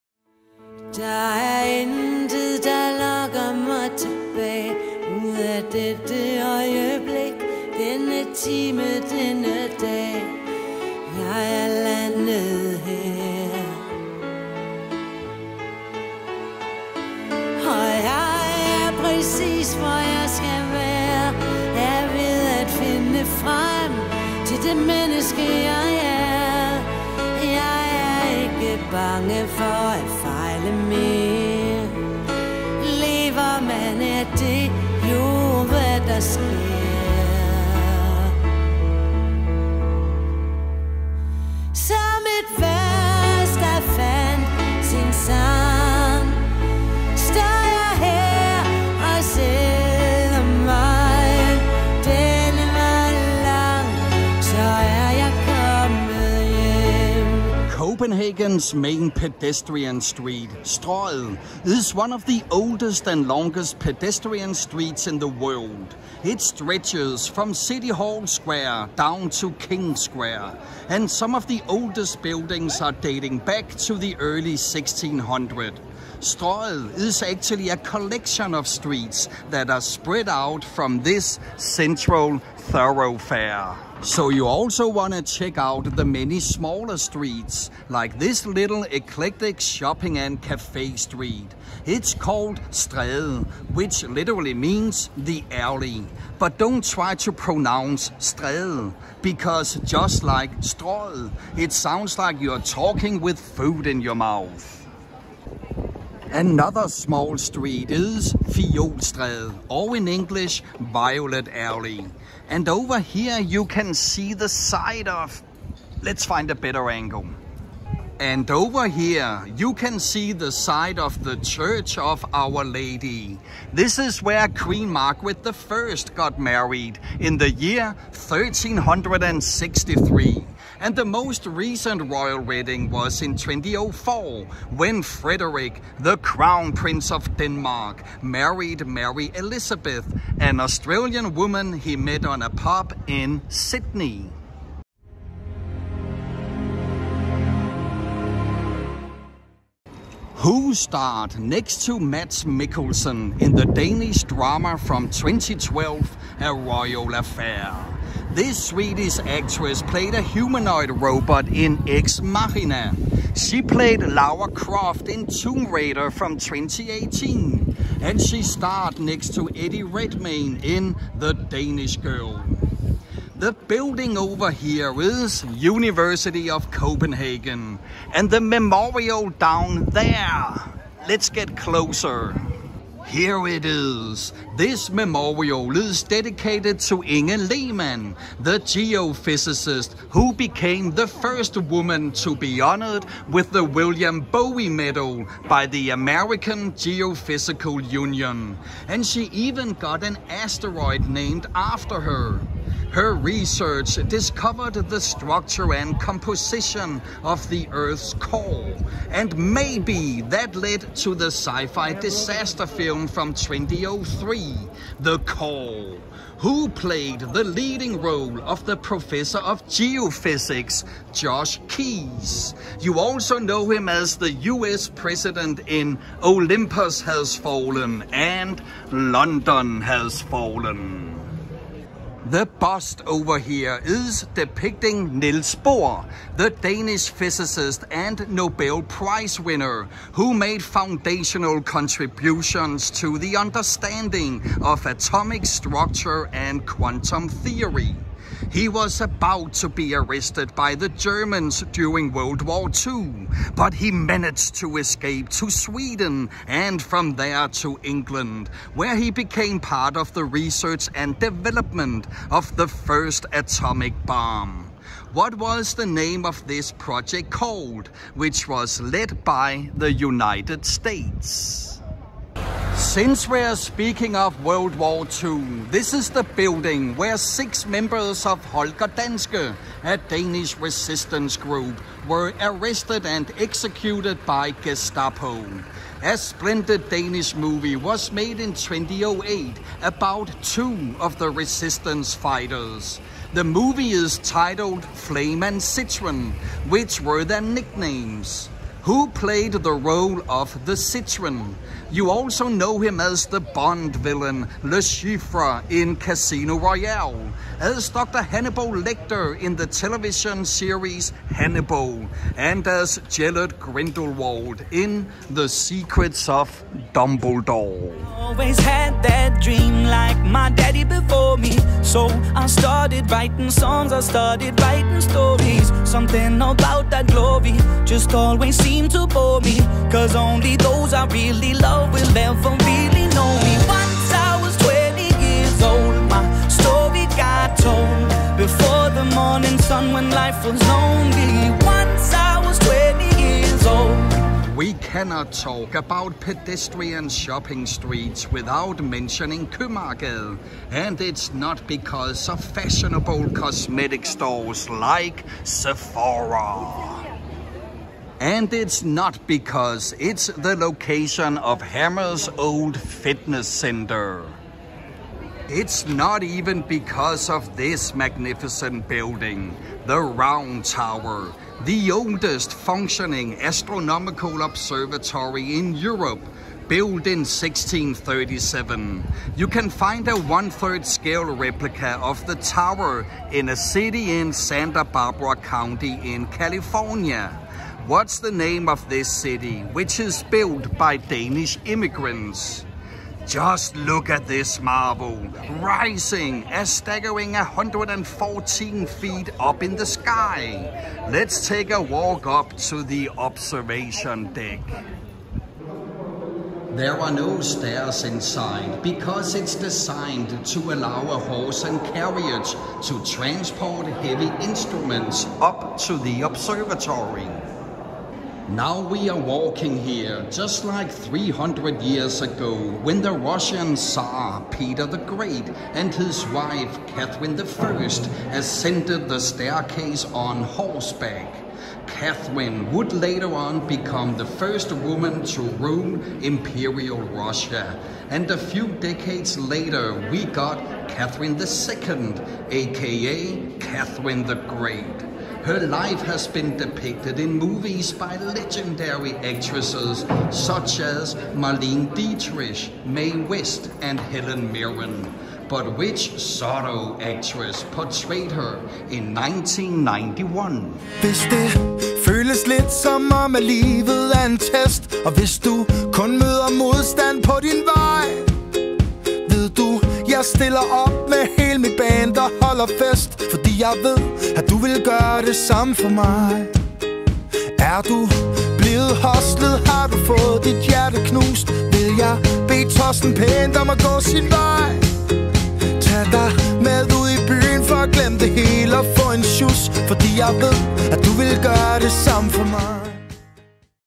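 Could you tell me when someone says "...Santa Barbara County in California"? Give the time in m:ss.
6:24.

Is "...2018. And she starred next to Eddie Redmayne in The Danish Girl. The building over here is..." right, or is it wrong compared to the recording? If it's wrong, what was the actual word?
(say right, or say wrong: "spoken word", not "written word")
right.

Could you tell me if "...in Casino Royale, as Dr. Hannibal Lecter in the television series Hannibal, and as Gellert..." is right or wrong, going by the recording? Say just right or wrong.
right.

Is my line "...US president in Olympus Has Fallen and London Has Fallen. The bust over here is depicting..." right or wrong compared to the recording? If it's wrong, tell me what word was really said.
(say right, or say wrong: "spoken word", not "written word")
right.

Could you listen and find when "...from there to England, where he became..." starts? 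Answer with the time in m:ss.
4:16.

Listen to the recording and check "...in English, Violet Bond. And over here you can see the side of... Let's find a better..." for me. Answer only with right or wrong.
wrong.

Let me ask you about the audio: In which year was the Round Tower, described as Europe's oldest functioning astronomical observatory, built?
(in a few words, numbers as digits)
1637.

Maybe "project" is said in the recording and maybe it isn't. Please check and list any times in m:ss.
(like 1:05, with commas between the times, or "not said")
4:26.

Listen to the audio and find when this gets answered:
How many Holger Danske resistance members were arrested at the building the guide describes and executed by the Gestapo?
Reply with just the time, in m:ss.
4:37.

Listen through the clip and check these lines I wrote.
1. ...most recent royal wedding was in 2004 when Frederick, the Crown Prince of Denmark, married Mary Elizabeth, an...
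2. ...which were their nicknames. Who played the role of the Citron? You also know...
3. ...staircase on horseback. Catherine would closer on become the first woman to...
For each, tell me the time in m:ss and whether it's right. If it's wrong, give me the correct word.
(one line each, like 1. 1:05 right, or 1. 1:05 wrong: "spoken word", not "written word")
1. 2:11 right
2. 4:56 right
3. 7:09 wrong: "later", not "closer".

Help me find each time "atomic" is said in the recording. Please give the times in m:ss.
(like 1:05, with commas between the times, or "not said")
4:04, 4:23.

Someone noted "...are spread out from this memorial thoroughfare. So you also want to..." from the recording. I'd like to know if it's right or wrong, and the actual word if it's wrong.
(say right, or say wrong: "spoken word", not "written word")
wrong: "central", not "memorial".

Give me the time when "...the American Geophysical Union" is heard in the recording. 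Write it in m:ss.
3:15.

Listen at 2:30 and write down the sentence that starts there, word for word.
Who starred next to Mads Mikkelsen in the Danish drama from 2012, A Royal Affair?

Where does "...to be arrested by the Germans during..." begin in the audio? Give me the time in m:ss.
4:09.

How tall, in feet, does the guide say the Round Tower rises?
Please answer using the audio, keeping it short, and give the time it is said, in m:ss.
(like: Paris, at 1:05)
114 feet, at 6:37.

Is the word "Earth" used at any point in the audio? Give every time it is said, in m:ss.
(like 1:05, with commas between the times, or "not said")
3:27.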